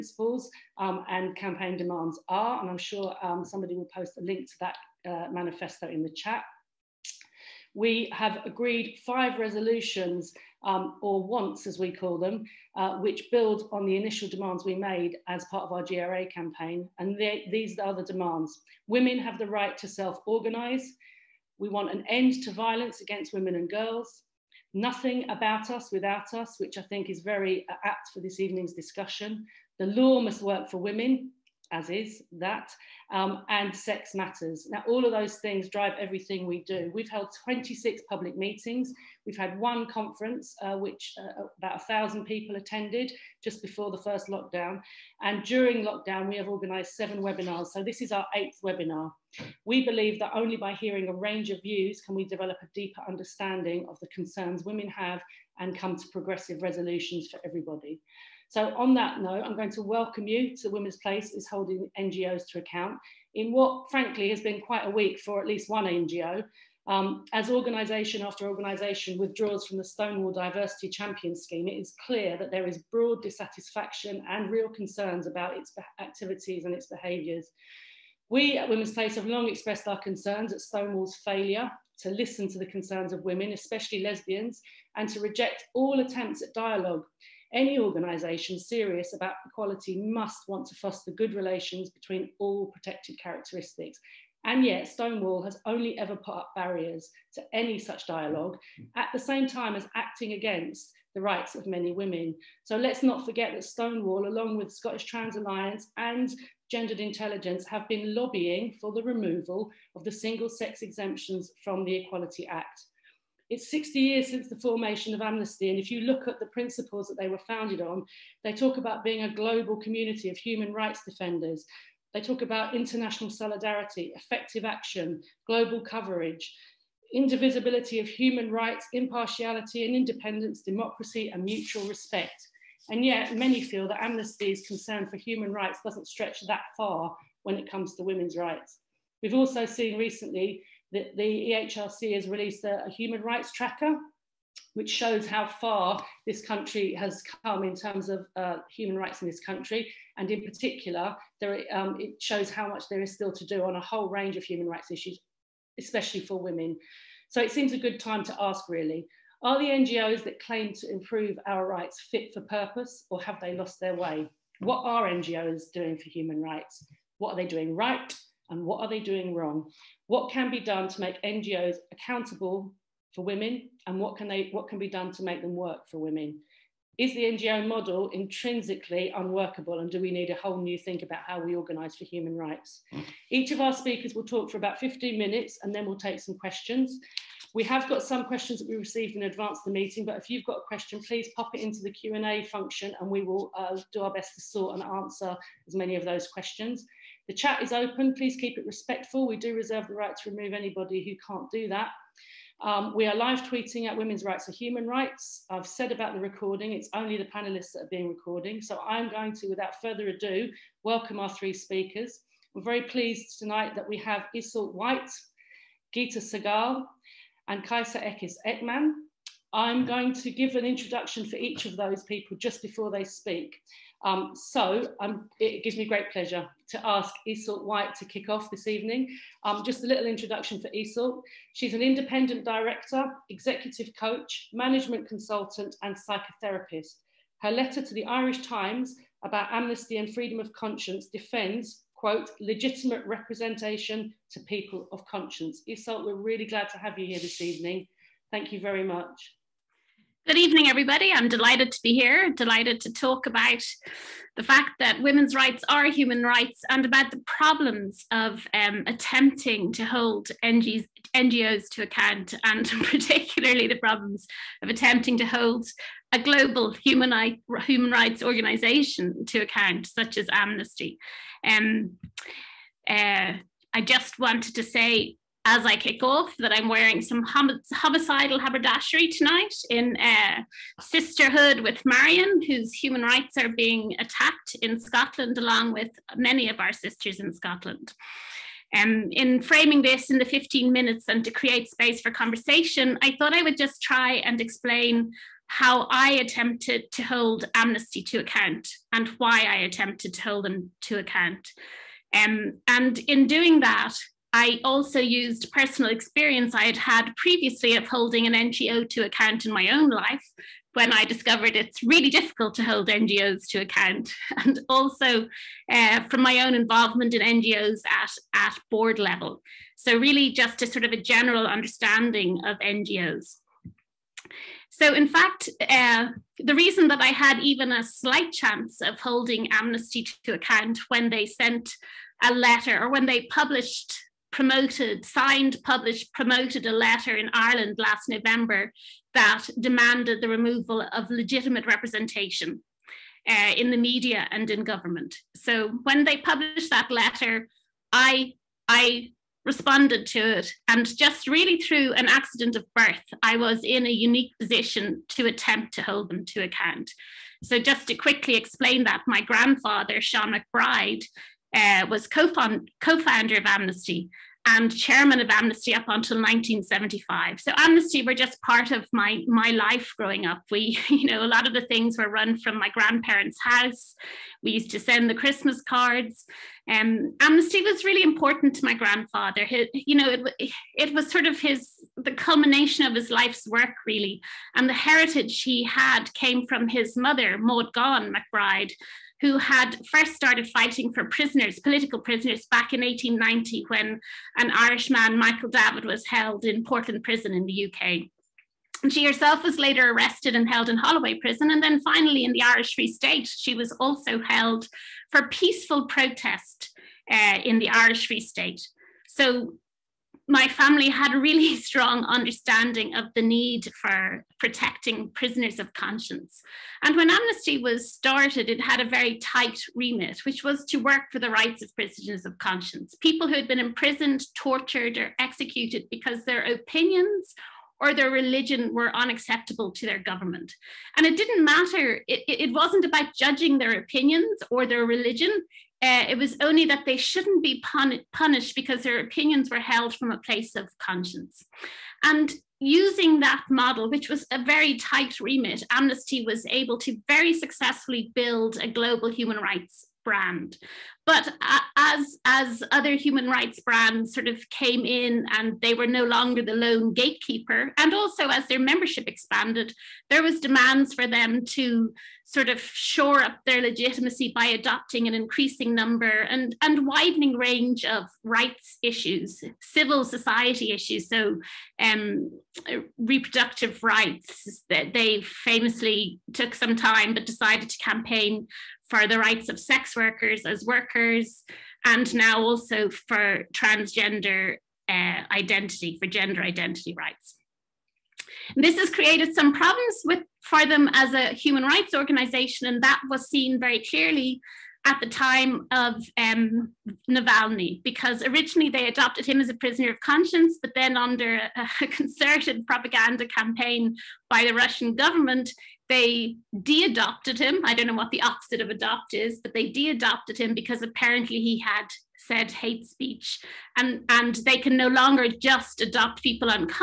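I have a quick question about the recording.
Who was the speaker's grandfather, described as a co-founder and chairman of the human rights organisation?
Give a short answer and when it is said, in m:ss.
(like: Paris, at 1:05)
Sean MacBride, at 6:00.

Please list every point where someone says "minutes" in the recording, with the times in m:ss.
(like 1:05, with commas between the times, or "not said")
3:05, 4:50.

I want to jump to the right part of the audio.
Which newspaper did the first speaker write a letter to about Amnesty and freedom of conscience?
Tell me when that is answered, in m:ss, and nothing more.
3:58.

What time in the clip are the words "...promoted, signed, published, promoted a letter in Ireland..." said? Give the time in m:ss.
5:34.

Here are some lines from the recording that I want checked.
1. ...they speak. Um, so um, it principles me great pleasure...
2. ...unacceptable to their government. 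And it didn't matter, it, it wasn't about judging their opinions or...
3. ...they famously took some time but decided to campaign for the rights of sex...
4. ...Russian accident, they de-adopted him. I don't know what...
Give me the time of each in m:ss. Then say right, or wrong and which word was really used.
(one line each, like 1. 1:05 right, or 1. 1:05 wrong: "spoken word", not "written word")
1. 3:42 wrong: "gives", not "principles"
2. 7:08 right
3. 7:54 right
4. 8:24 wrong: "government", not "accident".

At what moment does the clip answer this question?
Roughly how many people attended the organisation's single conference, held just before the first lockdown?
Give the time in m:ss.
0:41.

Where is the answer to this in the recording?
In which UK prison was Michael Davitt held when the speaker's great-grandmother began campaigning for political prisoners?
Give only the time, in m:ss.
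6:36.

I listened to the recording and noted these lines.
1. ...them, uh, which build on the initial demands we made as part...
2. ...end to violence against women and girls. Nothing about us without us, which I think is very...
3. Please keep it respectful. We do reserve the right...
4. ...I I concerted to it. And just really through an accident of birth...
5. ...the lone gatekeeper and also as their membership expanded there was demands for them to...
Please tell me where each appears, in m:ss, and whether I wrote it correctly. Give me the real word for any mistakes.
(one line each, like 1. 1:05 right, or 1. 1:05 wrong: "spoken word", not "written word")
1. 0:12 right
2. 0:22 right
3. 3:18 right
4. 5:47 wrong: "responded", not "concerted"
5. 7:36 right.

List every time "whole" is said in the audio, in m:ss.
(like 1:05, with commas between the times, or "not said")
2:33, 3:00.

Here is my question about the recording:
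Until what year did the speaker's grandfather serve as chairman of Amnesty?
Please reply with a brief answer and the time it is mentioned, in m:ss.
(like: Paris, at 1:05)
1975, at 6:06.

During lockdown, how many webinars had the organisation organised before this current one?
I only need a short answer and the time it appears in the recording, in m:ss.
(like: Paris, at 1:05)
7, at 0:46.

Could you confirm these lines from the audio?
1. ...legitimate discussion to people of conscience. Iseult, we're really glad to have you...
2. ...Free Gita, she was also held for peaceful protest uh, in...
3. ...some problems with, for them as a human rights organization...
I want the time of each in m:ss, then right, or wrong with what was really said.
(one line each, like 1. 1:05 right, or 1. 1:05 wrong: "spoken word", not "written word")
1. 4:02 wrong: "representation", not "discussion"
2. 6:42 wrong: "State", not "Gita"
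3. 8:09 right.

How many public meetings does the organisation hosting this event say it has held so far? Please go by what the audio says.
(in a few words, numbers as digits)
26.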